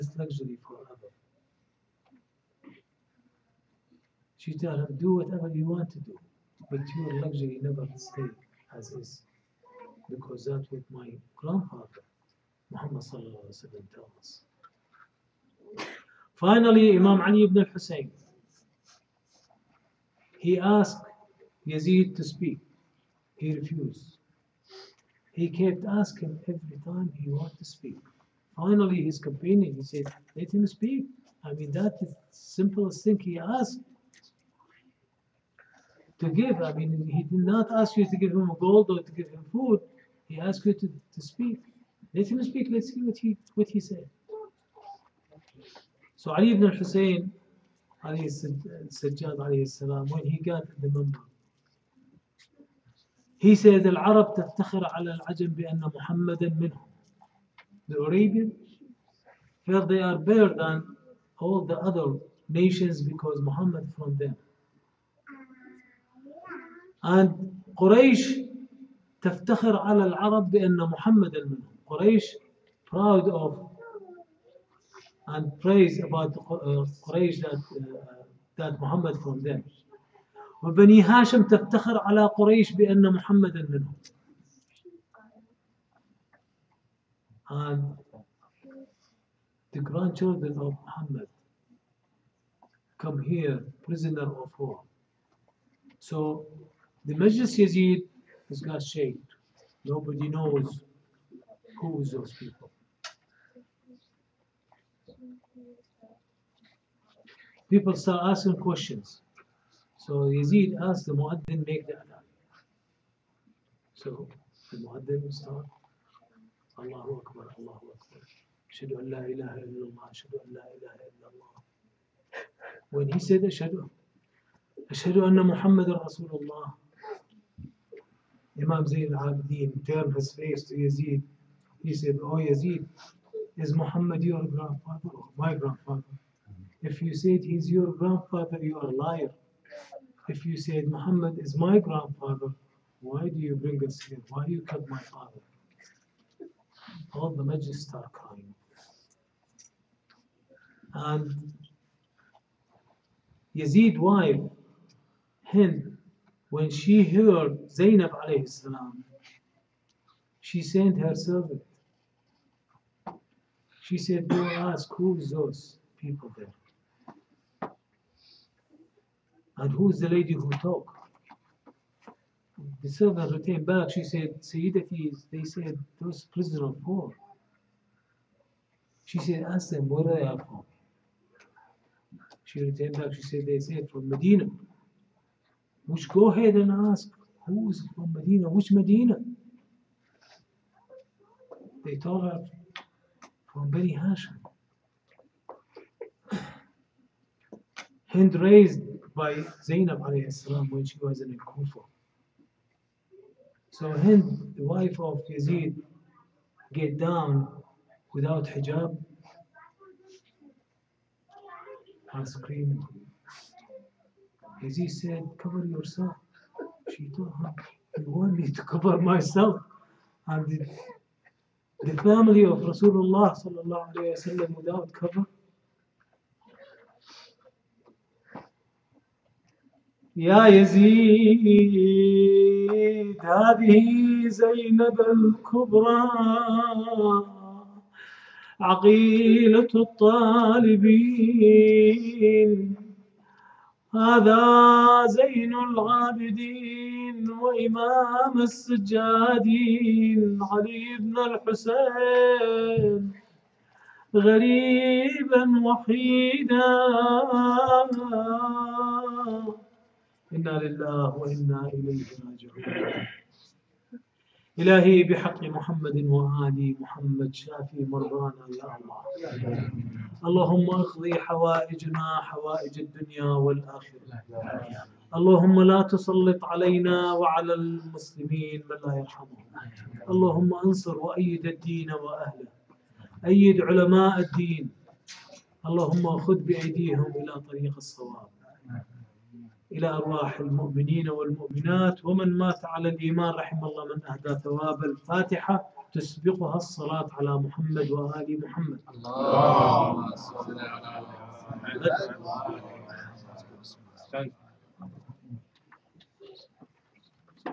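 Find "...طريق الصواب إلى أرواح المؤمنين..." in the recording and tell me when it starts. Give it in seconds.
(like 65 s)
287 s.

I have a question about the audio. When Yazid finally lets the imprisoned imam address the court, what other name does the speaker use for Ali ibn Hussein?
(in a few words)
Ali Sajjad.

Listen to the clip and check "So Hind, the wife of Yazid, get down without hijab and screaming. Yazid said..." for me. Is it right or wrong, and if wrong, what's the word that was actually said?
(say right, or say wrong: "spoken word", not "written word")
right.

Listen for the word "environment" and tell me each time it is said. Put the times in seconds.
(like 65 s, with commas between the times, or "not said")
not said.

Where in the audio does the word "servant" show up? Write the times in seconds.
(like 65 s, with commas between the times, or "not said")
161 s, 172 s.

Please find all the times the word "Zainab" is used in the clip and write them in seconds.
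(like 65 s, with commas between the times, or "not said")
157 s, 199 s.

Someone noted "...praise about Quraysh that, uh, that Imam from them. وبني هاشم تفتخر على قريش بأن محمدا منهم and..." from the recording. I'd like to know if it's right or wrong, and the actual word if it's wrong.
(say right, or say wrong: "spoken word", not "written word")
wrong: "Muhammad", not "Imam".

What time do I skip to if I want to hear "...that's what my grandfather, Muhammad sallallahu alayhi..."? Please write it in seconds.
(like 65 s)
10 s.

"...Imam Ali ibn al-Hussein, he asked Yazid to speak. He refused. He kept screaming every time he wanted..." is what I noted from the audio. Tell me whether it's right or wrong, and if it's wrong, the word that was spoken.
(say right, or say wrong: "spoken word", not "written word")
wrong: "asking", not "screaming".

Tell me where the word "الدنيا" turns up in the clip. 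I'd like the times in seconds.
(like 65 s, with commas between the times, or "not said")
272 s.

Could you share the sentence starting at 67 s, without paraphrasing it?
And Quraysh تفتخر على العرب بأن محمدا منهم.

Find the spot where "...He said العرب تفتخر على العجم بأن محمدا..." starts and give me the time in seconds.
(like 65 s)
53 s.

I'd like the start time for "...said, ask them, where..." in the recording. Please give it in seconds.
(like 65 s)
179 s.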